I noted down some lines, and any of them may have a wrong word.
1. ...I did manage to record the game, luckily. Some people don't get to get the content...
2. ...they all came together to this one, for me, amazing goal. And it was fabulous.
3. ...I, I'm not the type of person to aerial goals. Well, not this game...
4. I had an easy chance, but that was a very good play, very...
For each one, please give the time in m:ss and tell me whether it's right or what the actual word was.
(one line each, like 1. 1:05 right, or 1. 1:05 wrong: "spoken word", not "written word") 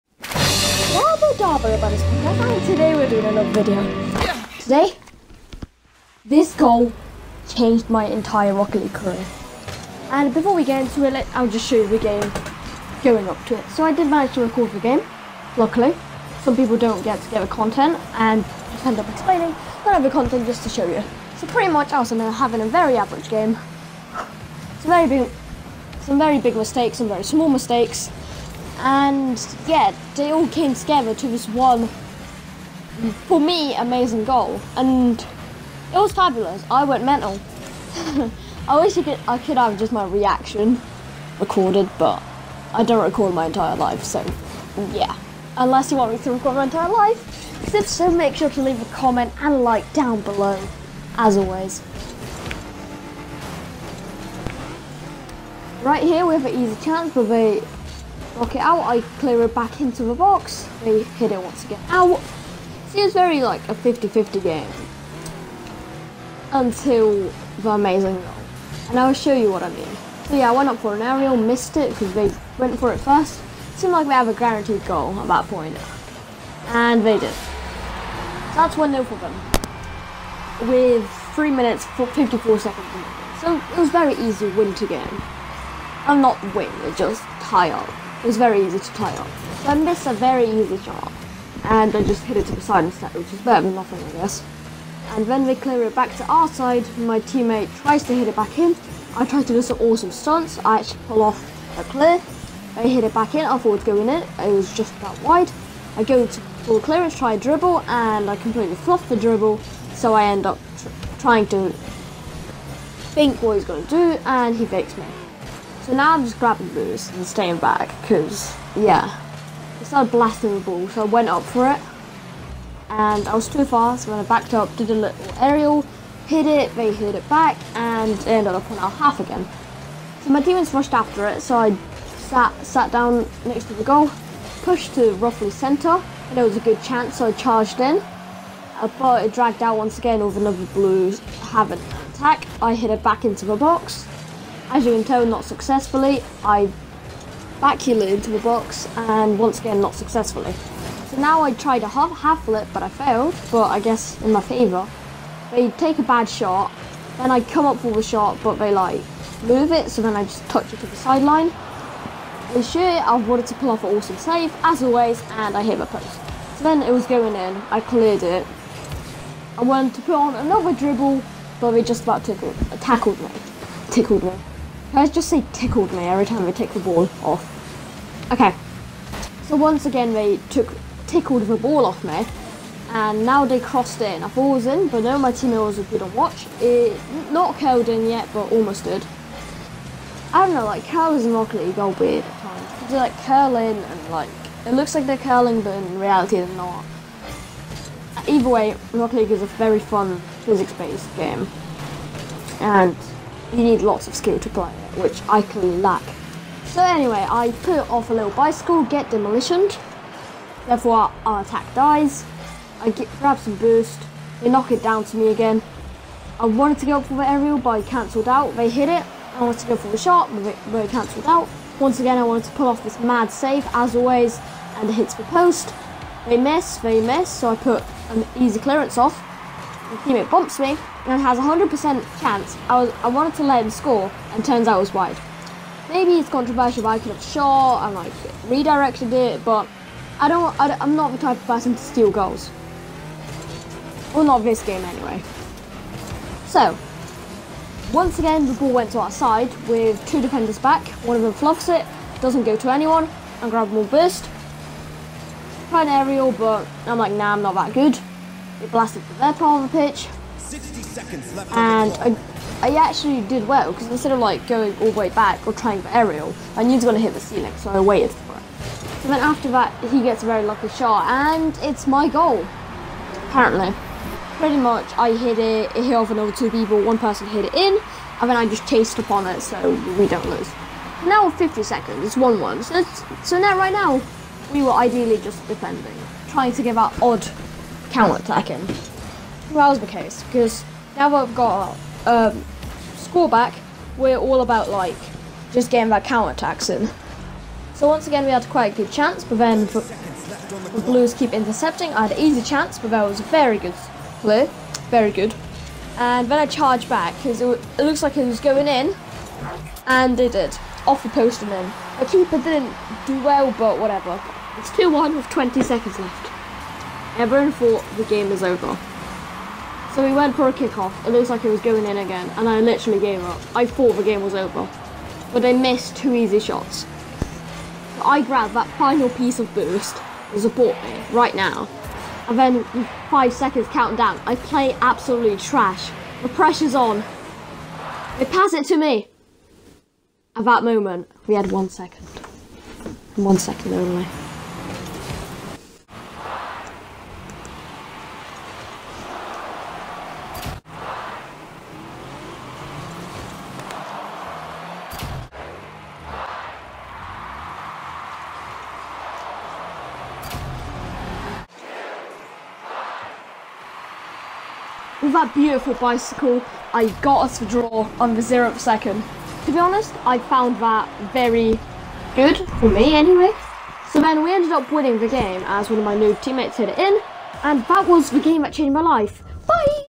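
1. 0:13 right
2. 0:30 right
3. 4:00 wrong: "steal", not "aerial"
4. 5:01 right.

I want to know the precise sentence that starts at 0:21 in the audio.
So pretty much I was having a very average game.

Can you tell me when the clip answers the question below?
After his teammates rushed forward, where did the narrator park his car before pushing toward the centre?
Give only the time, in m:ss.
2:13.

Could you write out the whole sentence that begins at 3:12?
They like curl in and like it looks like they're curling, but in reality they're not.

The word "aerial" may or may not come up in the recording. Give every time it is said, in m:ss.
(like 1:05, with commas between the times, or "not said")
1:11, 2:05, 3:37, 4:15, 4:25.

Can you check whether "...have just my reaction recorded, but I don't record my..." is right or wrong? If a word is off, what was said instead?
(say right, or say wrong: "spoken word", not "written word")
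right.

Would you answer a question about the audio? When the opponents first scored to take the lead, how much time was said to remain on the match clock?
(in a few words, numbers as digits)
3 minutes 54 seconds.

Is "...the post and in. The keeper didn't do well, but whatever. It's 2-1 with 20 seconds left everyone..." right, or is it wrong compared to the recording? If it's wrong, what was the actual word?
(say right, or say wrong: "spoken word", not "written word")
right.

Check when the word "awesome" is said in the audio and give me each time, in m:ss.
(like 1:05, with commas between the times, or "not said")
1:39, 2:43.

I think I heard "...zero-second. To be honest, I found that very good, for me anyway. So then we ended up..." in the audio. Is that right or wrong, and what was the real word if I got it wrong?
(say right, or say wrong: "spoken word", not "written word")
right.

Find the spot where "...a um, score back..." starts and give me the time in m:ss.
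4:52.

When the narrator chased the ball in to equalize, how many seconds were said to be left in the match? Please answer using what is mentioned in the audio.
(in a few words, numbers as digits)
50 seconds.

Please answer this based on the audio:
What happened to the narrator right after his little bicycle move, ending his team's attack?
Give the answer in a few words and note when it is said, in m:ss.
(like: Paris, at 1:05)
demolitioned, at 3:29.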